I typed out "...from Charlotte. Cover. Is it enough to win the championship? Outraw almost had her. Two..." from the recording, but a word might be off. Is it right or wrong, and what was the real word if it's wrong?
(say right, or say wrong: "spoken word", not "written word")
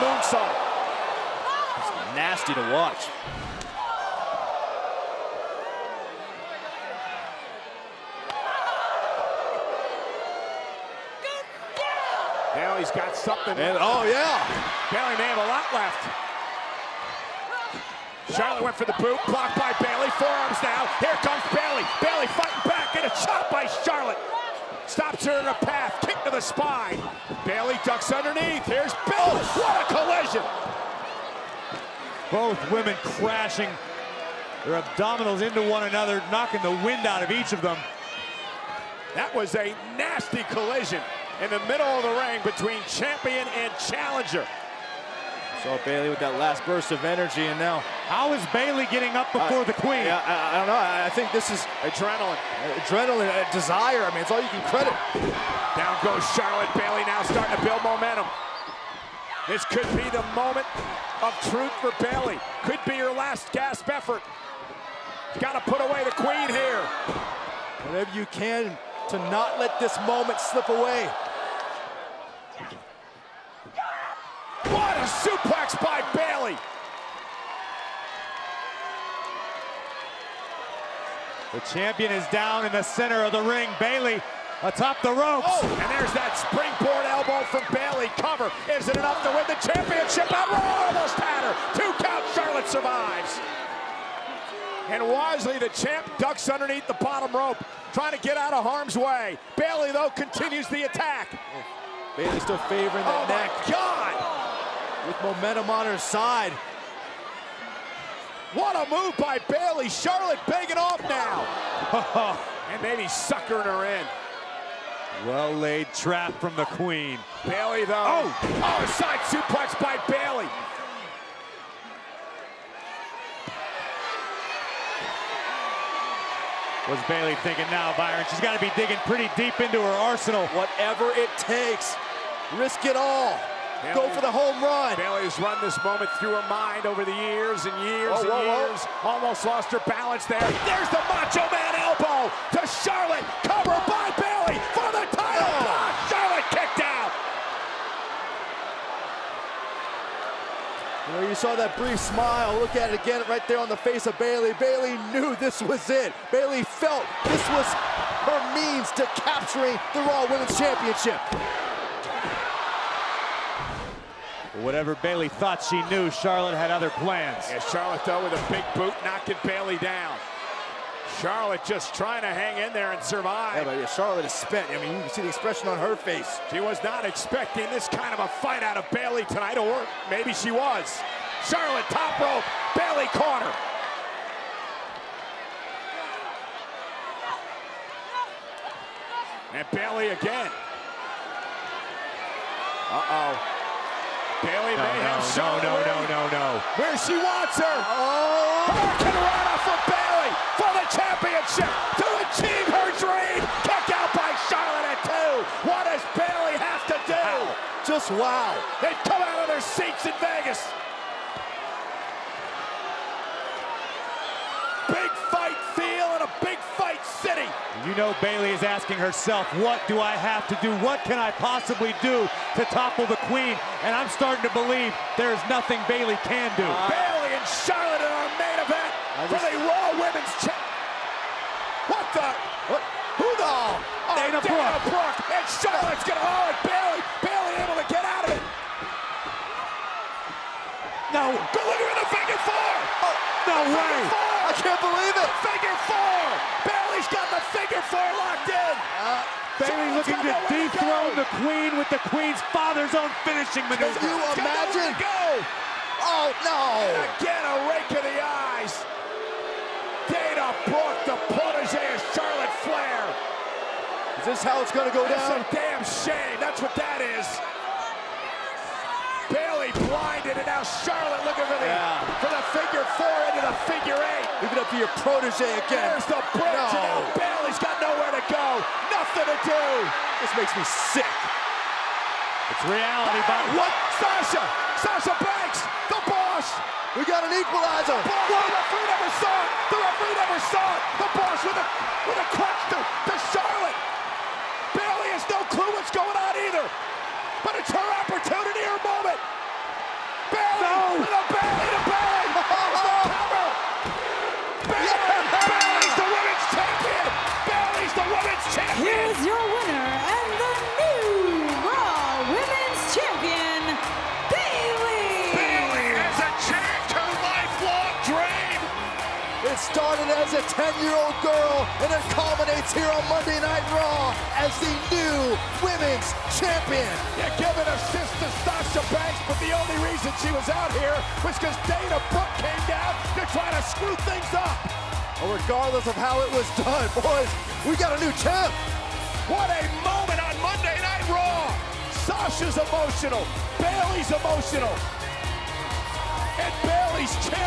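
wrong: "Bayley", not "Charlotte".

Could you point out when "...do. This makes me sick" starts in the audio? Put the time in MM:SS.
04:39.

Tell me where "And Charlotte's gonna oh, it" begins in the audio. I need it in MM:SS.
03:55.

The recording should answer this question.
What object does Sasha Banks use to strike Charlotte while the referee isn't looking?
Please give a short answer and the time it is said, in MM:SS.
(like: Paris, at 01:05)
A crutch, at 04:52.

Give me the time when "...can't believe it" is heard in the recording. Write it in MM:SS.
04:04.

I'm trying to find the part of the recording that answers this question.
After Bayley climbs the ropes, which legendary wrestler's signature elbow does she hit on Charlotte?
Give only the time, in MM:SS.
02:21.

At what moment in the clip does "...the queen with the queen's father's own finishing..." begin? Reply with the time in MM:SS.
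04:11.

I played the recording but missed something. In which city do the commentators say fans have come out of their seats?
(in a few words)
Vegas.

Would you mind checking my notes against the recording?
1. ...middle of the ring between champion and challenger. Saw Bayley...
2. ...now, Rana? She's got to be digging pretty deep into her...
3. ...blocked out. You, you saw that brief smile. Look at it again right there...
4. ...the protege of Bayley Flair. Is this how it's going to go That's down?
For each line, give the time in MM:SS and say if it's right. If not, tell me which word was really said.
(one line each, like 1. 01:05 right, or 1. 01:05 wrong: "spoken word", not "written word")
1. 00:41 right
2. 02:07 wrong: "Byron", not "Rana"
3. 02:26 wrong: "kicked", not "blocked"
4. 04:21 wrong: "Charlotte", not "Bayley".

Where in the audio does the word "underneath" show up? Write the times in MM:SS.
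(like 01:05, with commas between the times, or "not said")
00:28, 01:36.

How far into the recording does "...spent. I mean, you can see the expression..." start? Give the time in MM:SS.
02:54.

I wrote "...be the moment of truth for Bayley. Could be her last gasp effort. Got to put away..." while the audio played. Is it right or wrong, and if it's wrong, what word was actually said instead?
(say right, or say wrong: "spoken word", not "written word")
right.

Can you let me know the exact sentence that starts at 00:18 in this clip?
Charlotte went for the boot, blocked by Bayley.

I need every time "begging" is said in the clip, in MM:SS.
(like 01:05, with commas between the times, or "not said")
01:50.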